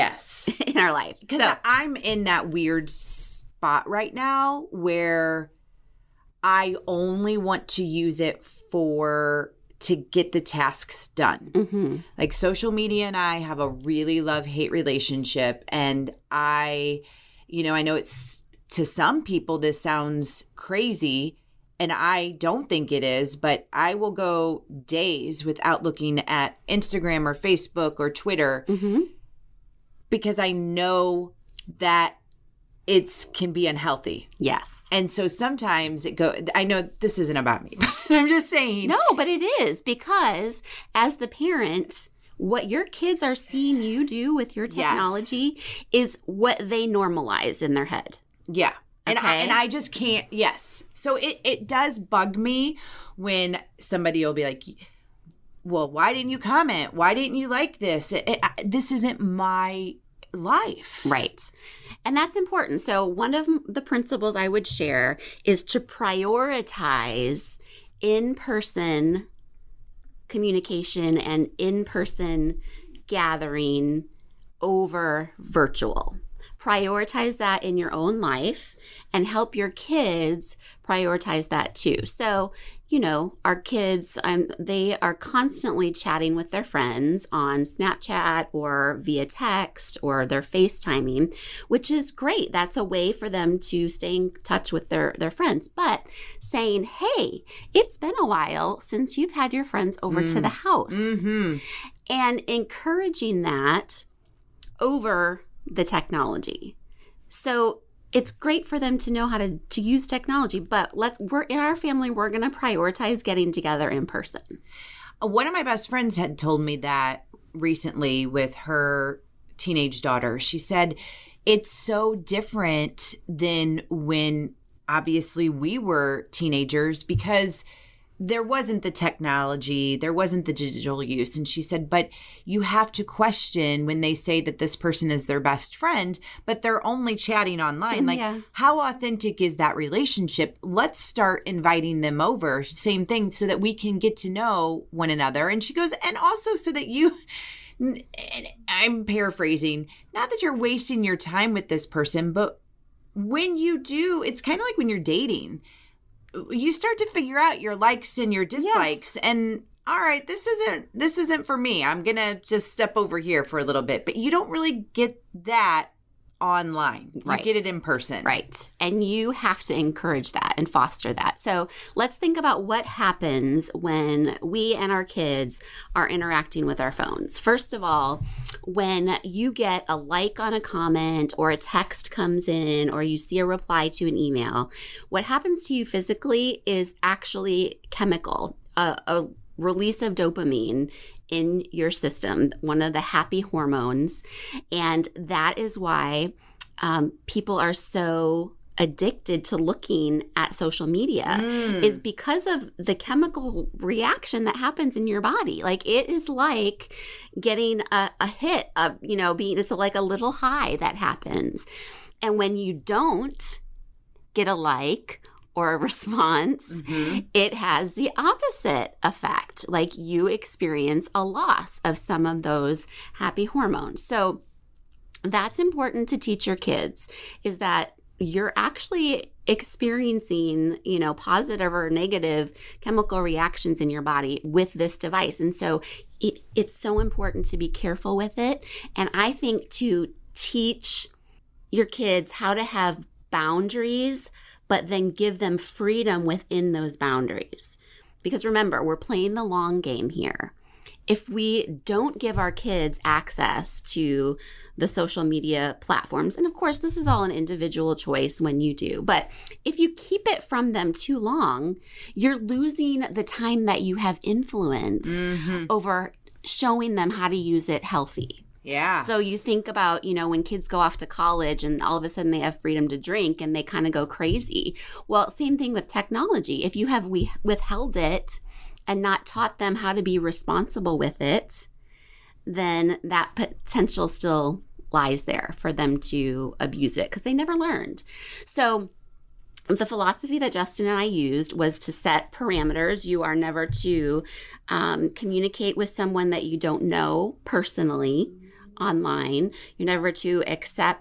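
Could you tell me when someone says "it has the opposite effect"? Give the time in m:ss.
3:37.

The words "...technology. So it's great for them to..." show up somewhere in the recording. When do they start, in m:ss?
1:45.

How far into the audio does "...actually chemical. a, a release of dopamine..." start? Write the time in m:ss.
3:07.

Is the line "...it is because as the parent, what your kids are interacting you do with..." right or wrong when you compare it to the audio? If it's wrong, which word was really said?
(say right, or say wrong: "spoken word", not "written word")
wrong: "seeing", not "interacting".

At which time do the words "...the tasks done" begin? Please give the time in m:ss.
0:10.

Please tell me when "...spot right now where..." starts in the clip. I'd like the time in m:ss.
0:02.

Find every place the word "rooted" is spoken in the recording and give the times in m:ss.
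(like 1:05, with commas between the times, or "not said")
not said.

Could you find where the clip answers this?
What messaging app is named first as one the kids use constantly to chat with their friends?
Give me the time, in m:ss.
1:27.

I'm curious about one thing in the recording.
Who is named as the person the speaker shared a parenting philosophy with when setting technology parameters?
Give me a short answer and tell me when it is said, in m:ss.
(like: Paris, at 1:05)
Justin, at 4:50.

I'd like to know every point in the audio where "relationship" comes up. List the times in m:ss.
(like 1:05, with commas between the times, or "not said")
0:14, 2:19.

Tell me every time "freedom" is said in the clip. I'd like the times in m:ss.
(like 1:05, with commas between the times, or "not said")
4:05, 4:32.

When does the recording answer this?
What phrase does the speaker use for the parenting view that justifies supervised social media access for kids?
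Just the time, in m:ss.
4:09.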